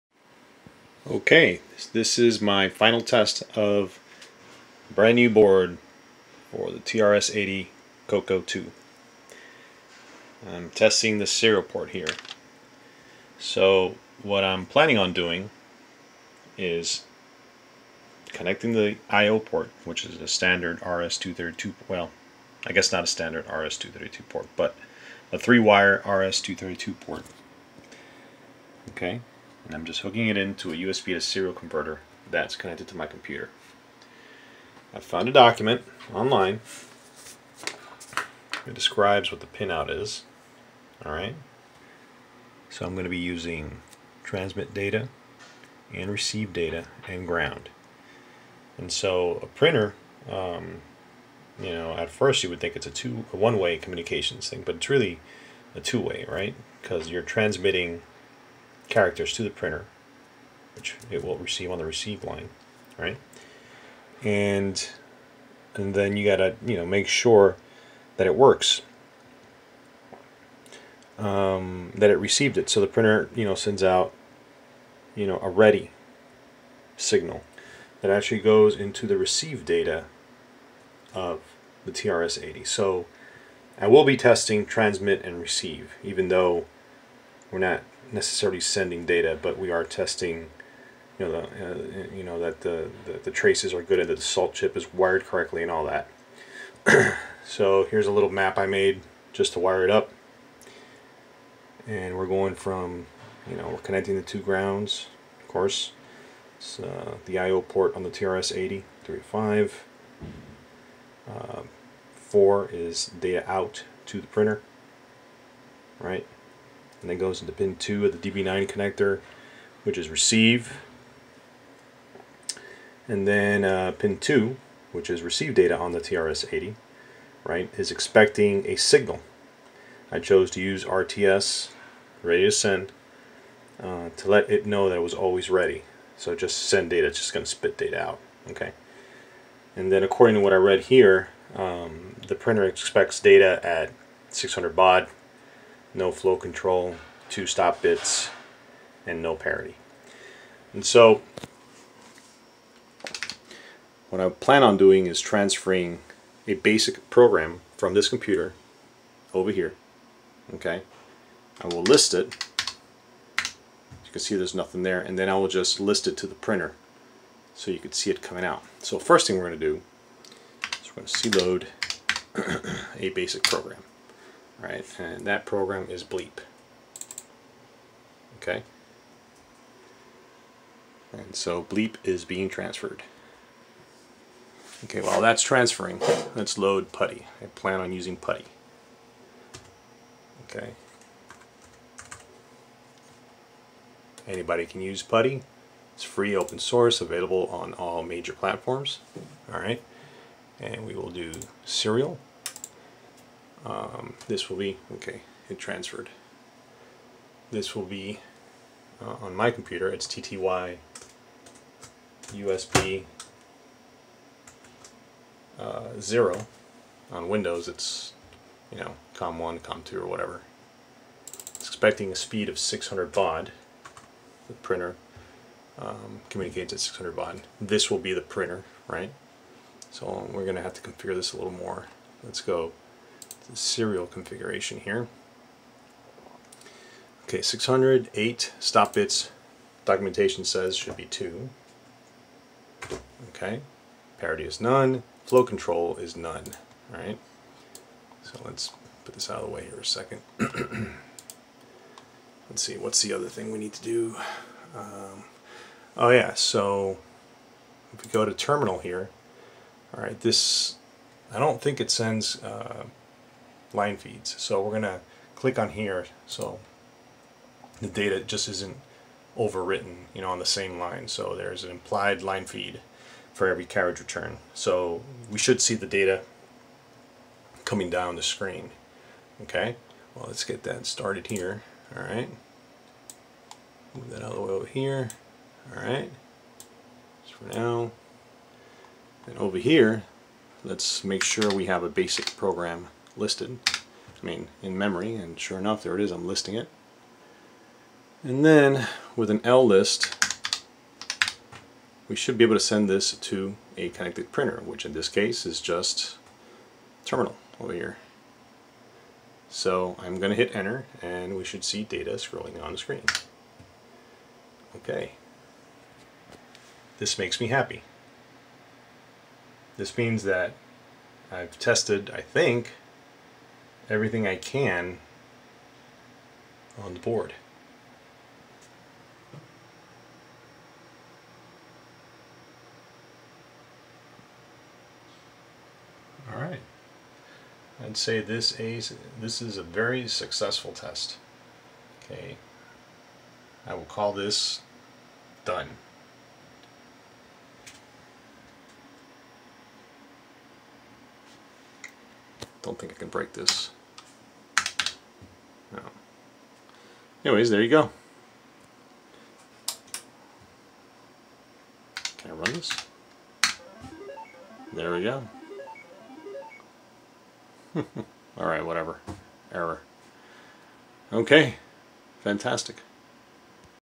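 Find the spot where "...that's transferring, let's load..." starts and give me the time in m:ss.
3:05.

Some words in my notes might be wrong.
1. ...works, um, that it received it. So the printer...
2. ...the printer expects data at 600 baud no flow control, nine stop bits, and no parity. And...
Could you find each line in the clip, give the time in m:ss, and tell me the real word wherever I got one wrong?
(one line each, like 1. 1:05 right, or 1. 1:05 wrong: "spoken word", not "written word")
1. 1:08 right
2. 2:22 wrong: "two", not "nine".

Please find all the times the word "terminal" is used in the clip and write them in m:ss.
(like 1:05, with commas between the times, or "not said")
4:18, 5:07.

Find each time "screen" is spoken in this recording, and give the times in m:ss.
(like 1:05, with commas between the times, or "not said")
4:38, 5:12.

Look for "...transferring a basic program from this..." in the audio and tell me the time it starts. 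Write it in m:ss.
2:35.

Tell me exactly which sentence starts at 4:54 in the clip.
I mean, in memory, and sure enough, there it is, I'm listing it.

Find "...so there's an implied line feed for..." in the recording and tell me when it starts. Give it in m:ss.
4:31.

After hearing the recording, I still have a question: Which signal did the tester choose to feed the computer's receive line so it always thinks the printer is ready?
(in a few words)
RTS.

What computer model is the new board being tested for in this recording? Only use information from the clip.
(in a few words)
TRS-80 CoCo 2.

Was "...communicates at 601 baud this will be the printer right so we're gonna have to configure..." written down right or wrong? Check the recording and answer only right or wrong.
wrong.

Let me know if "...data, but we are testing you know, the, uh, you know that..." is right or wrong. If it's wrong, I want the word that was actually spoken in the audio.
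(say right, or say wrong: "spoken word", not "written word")
right.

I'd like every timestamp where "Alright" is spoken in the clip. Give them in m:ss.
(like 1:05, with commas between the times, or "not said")
0:41, 6:08.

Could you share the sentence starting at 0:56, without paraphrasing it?
Because you're transmitting characters to the printer, which it will receive on the receive line, right?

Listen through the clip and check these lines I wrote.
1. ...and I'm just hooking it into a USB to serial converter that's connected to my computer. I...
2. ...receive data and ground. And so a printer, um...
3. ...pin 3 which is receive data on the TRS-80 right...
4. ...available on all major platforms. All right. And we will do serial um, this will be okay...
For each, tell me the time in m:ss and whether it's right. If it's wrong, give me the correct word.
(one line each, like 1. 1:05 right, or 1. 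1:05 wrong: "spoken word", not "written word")
1. 0:29 right
2. 0:46 right
3. 2:03 wrong: "2", not "3"
4. 3:16 right.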